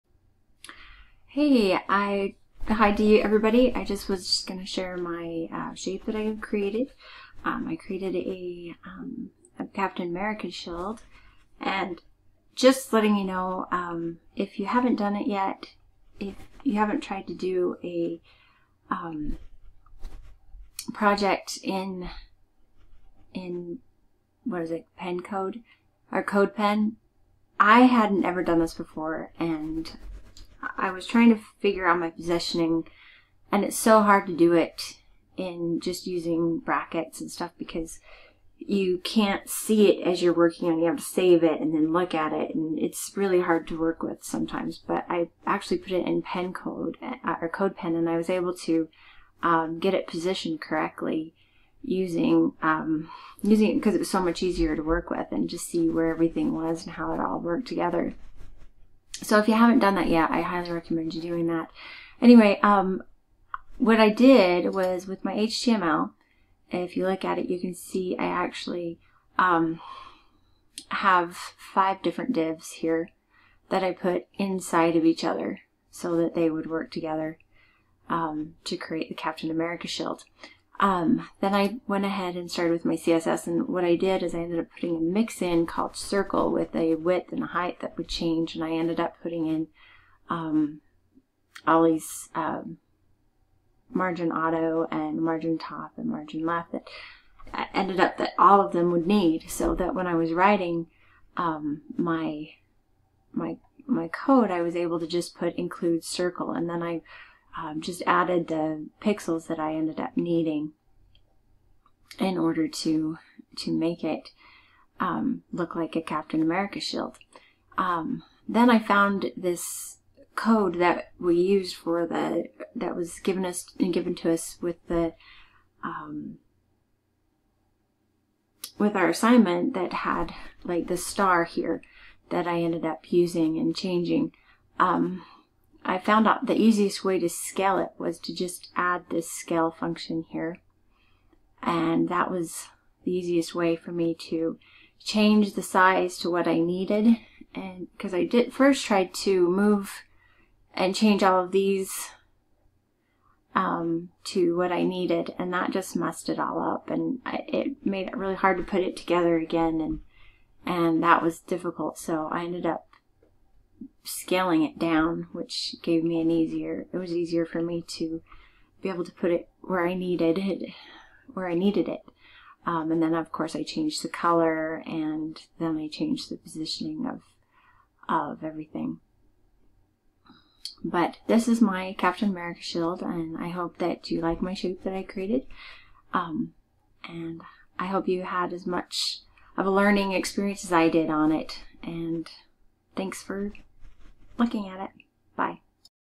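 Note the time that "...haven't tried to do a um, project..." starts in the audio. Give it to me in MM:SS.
00:16.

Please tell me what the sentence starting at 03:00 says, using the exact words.
But this is my Captain America shield and I hope that you like my shape that I created.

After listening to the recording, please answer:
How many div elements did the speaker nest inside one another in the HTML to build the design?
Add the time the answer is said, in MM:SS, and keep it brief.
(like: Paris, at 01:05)
5, at 01:11.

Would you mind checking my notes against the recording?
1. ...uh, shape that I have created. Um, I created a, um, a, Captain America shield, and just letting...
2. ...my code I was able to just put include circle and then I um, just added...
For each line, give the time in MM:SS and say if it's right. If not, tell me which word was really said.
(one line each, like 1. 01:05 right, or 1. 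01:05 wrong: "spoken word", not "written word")
1. 00:05 right
2. 01:43 right.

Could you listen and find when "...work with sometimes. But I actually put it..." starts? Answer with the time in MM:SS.
00:43.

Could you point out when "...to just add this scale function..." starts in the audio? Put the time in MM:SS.
02:18.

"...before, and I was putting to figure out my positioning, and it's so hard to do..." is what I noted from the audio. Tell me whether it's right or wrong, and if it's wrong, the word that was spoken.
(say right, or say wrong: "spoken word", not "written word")
wrong: "trying", not "putting".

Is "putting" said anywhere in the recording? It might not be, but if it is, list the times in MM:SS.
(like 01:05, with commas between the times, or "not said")
01:24, 01:29.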